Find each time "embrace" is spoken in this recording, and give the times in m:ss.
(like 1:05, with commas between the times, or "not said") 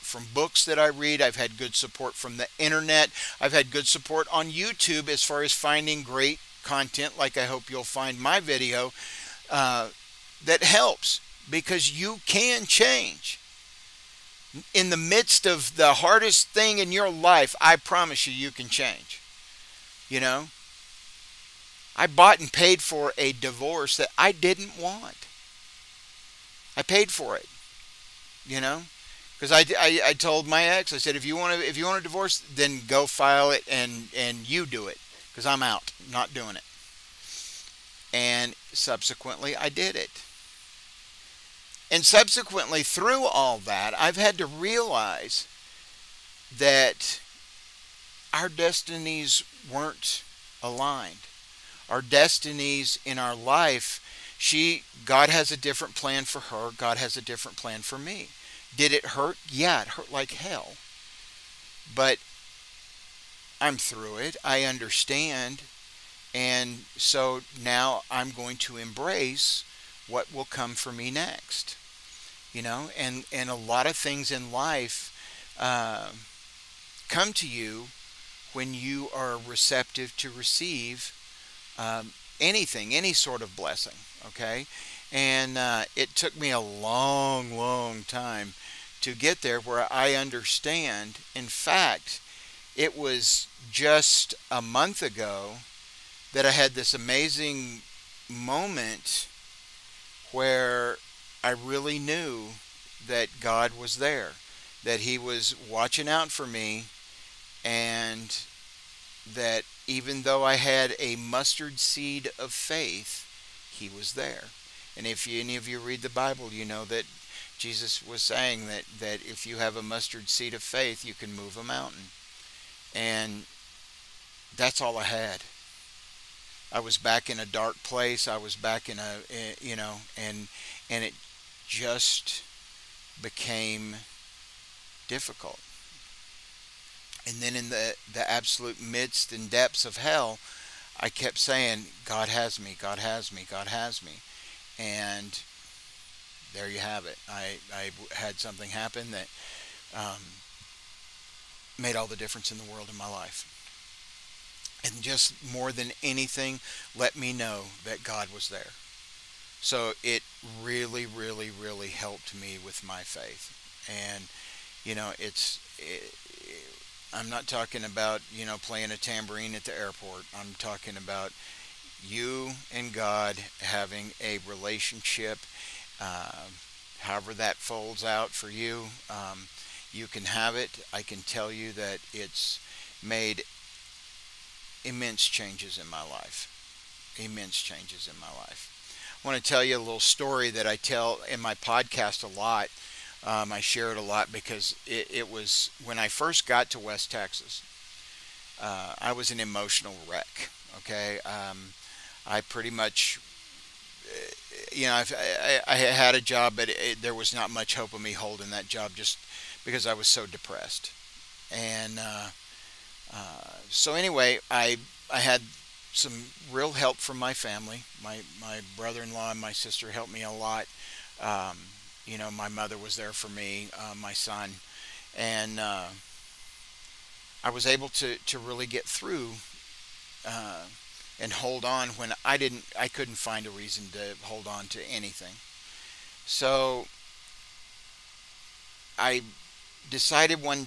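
1:08.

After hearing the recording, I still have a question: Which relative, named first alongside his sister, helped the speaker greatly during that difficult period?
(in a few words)
Brother-in-law.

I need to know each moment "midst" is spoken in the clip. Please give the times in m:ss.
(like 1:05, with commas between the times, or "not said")
0:14, 2:18.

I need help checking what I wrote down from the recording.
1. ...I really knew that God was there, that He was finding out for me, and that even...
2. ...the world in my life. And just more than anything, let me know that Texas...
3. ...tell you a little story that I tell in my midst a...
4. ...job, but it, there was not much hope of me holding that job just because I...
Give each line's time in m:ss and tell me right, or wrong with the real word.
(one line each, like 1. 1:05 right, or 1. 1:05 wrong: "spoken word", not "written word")
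1. 1:41 wrong: "watching", not "finding"
2. 2:32 wrong: "God", not "Texas"
3. 3:09 wrong: "podcast", not "midst"
4. 3:26 right.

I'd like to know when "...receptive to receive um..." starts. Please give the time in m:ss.
1:19.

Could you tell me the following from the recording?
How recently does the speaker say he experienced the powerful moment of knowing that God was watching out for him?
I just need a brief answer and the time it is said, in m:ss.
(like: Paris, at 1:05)
A month ago, at 1:34.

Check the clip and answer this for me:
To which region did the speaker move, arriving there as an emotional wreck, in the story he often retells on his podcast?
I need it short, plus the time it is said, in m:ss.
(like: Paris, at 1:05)
West Texas, at 3:16.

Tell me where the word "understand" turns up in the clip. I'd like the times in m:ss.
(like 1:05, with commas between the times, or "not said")
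1:04, 1:30.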